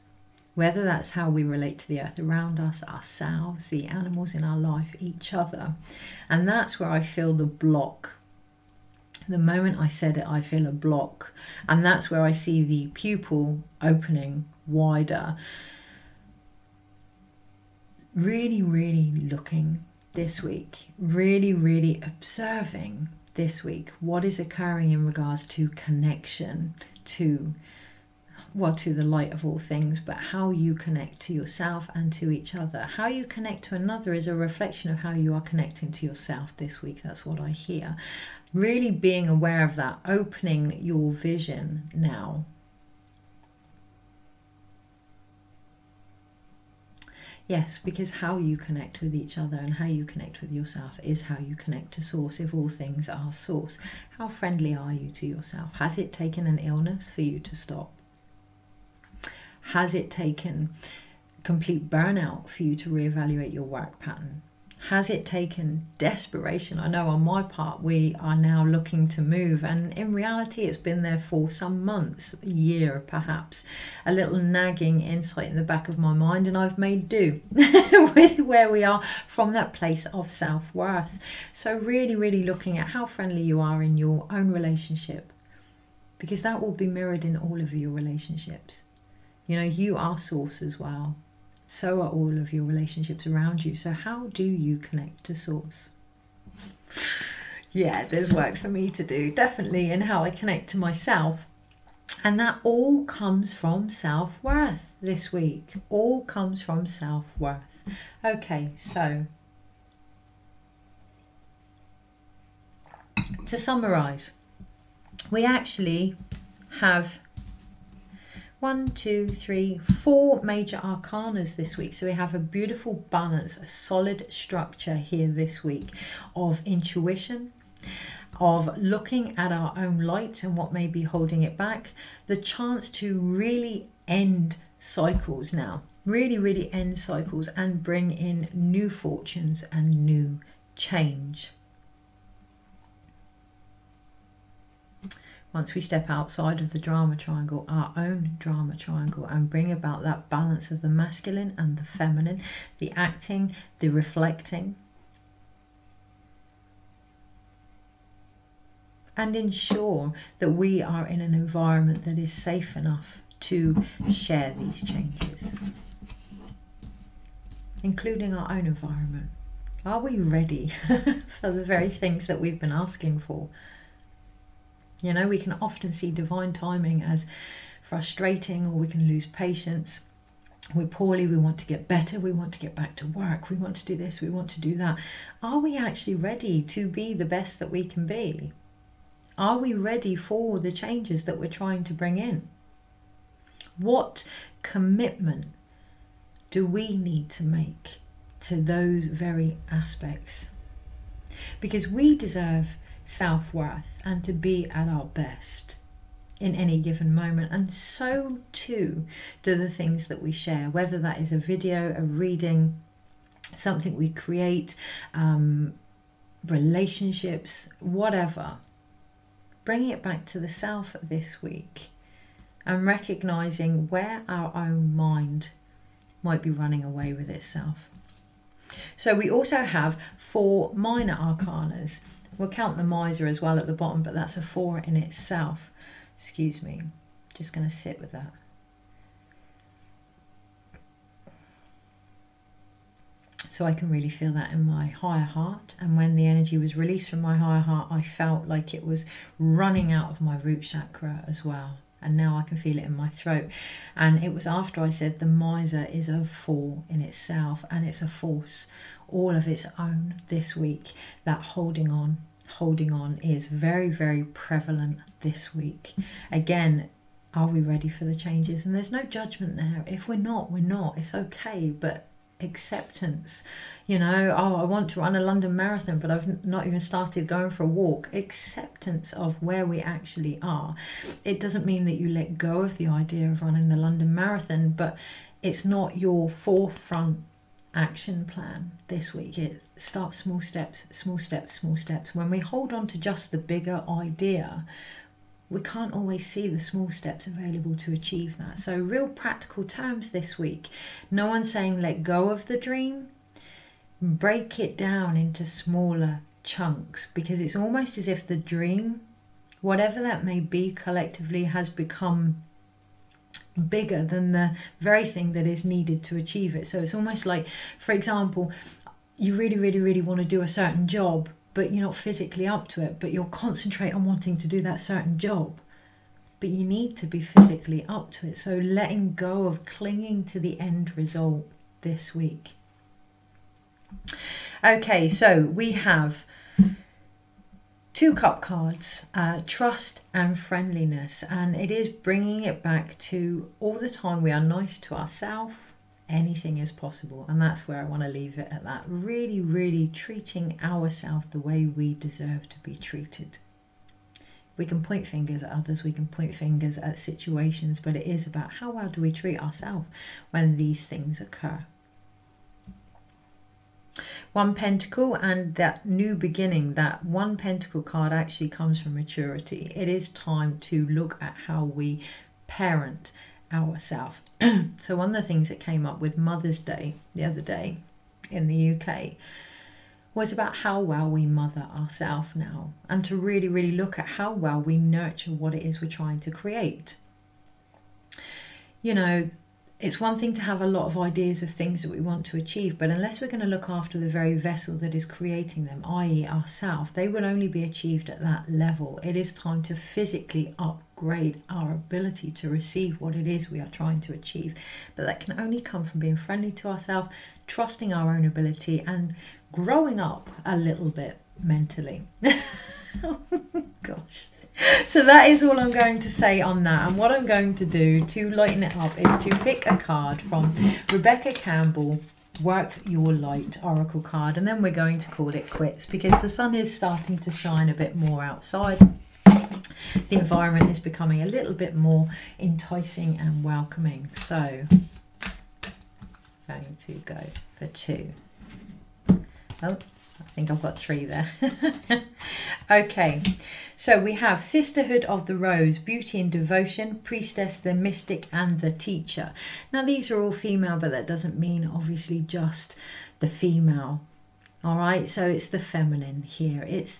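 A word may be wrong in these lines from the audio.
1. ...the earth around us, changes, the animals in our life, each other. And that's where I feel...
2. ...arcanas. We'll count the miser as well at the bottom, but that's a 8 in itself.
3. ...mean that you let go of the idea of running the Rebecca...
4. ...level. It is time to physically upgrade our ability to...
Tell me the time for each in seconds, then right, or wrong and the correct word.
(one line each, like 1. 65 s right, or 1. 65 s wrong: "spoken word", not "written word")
1. 1 s wrong: "ourselves", not "changes"
2. 231 s wrong: "4", not "8"
3. 281 s wrong: "London", not "Rebecca"
4. 398 s right.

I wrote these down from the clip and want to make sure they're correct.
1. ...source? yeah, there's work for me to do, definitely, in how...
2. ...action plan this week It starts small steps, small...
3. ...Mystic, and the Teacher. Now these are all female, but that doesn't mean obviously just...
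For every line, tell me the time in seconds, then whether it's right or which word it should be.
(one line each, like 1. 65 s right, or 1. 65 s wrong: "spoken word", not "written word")
1. 95 s right
2. 287 s right
3. 447 s right.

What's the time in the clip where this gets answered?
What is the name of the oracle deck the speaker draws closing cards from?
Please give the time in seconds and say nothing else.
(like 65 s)
422 s.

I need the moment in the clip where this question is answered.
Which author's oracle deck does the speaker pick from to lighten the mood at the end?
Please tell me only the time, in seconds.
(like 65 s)
420 s.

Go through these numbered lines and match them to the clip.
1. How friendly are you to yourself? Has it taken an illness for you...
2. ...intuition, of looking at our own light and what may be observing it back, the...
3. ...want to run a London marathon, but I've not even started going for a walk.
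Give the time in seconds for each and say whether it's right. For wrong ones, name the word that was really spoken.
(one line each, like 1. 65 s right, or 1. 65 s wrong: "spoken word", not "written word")
1. 54 s right
2. 126 s wrong: "holding", not "observing"
3. 274 s right.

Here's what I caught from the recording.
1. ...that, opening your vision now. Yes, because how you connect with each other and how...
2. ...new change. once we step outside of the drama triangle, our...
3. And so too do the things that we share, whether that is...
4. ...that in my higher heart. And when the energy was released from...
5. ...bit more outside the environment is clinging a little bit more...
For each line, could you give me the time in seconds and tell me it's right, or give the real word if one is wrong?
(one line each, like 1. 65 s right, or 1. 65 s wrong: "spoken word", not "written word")
1. 39 s right
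2. 140 s right
3. 207 s right
4. 244 s right
5. 427 s wrong: "becoming", not "clinging".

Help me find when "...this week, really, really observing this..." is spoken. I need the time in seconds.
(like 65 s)
20 s.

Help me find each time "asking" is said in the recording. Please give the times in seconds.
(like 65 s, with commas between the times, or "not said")
172 s.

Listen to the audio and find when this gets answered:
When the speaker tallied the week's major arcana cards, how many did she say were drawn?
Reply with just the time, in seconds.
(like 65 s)
118 s.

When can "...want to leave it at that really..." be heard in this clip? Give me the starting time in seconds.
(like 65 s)
347 s.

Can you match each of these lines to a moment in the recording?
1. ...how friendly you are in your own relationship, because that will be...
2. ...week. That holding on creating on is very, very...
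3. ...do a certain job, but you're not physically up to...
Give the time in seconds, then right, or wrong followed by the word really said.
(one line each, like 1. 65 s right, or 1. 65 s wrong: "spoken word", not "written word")
1. 82 s right
2. 260 s wrong: "holding", not "creating"
3. 320 s right.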